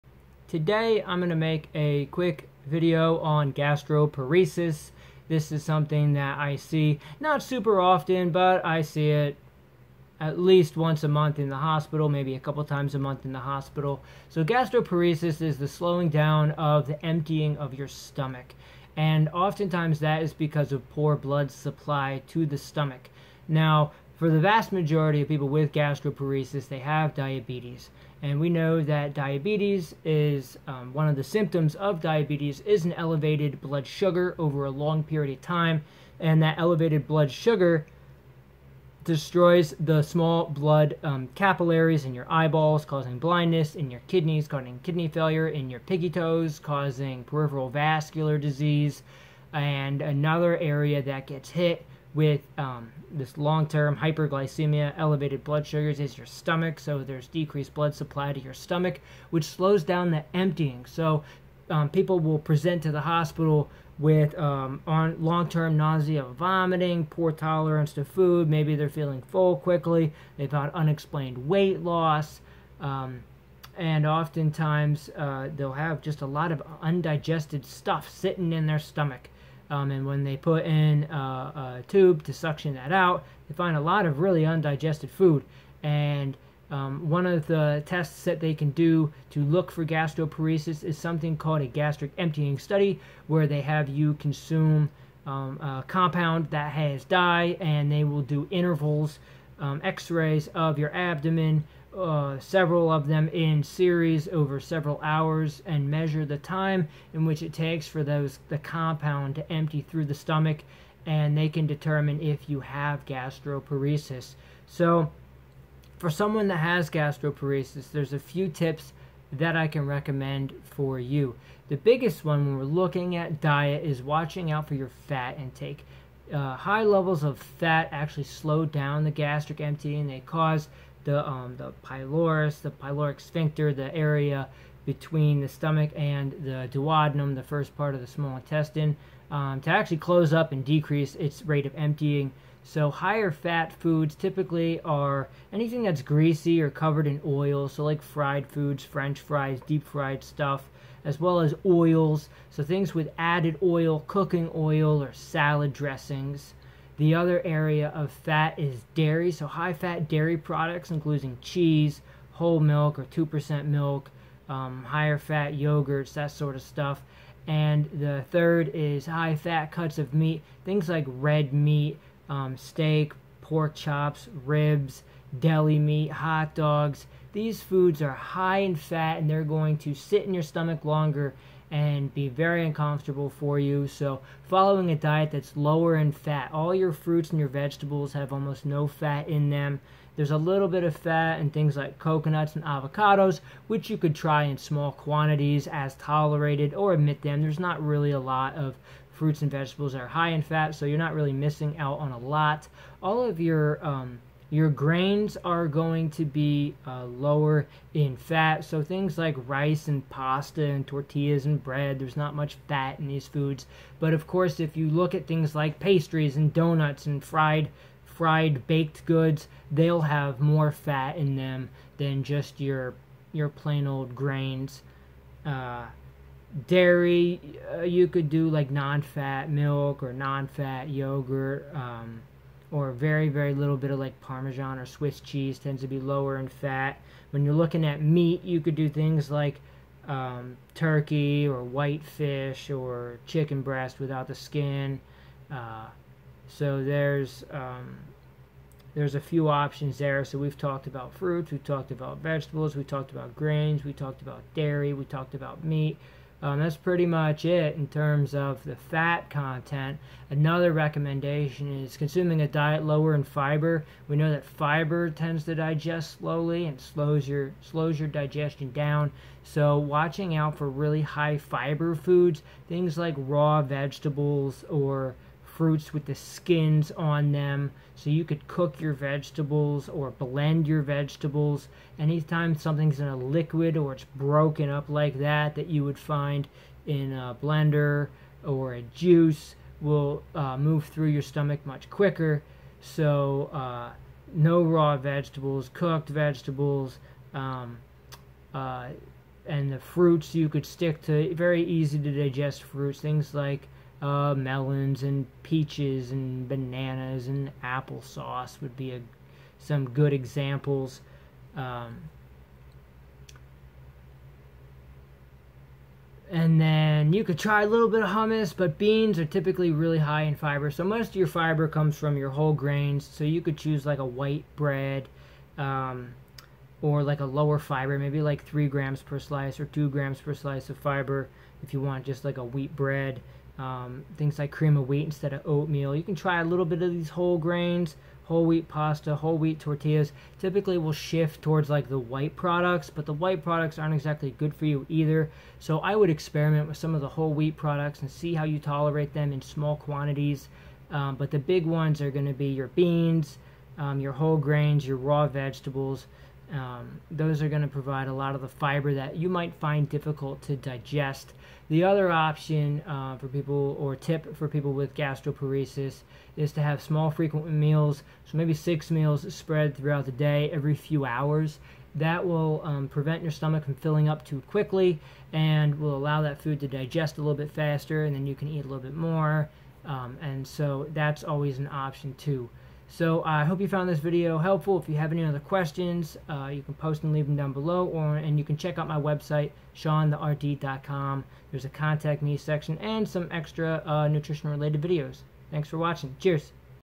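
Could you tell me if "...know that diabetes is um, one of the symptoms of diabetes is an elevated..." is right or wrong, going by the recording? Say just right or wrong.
right.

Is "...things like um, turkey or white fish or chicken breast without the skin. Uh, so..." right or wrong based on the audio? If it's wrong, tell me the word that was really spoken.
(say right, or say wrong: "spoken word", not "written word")
right.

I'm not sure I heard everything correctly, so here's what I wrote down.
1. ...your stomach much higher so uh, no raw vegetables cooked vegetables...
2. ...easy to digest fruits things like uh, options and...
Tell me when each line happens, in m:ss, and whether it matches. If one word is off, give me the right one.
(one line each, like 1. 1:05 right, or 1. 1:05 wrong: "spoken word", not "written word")
1. 4:51 wrong: "quicker", not "higher"
2. 5:01 wrong: "melons", not "options".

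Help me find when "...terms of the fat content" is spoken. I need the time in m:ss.
4:17.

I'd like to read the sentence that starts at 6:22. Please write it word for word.
So uh, I uh, hope you found this video helpful.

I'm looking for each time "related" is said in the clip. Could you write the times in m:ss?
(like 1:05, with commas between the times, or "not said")
6:34.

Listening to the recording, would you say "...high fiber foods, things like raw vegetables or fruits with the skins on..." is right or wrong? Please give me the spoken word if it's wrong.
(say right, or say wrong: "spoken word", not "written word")
right.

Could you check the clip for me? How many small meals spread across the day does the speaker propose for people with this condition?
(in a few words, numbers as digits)
6.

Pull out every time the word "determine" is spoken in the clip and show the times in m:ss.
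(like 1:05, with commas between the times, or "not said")
1:51.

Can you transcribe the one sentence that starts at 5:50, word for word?
Um, but the big ones are going to be your beans, um, your whole grains, your raw vegetables.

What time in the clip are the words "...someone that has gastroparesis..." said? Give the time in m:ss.
1:56.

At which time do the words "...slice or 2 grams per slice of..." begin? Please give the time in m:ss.
5:29.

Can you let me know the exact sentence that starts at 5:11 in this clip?
Um, and then you could try a little bit of hummus, but beans are typically really high in fiber.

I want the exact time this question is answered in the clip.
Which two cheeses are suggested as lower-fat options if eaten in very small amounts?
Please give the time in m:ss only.
3:54.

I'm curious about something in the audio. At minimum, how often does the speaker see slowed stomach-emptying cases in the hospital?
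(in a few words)
once a month.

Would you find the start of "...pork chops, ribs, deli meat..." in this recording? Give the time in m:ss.
2:53.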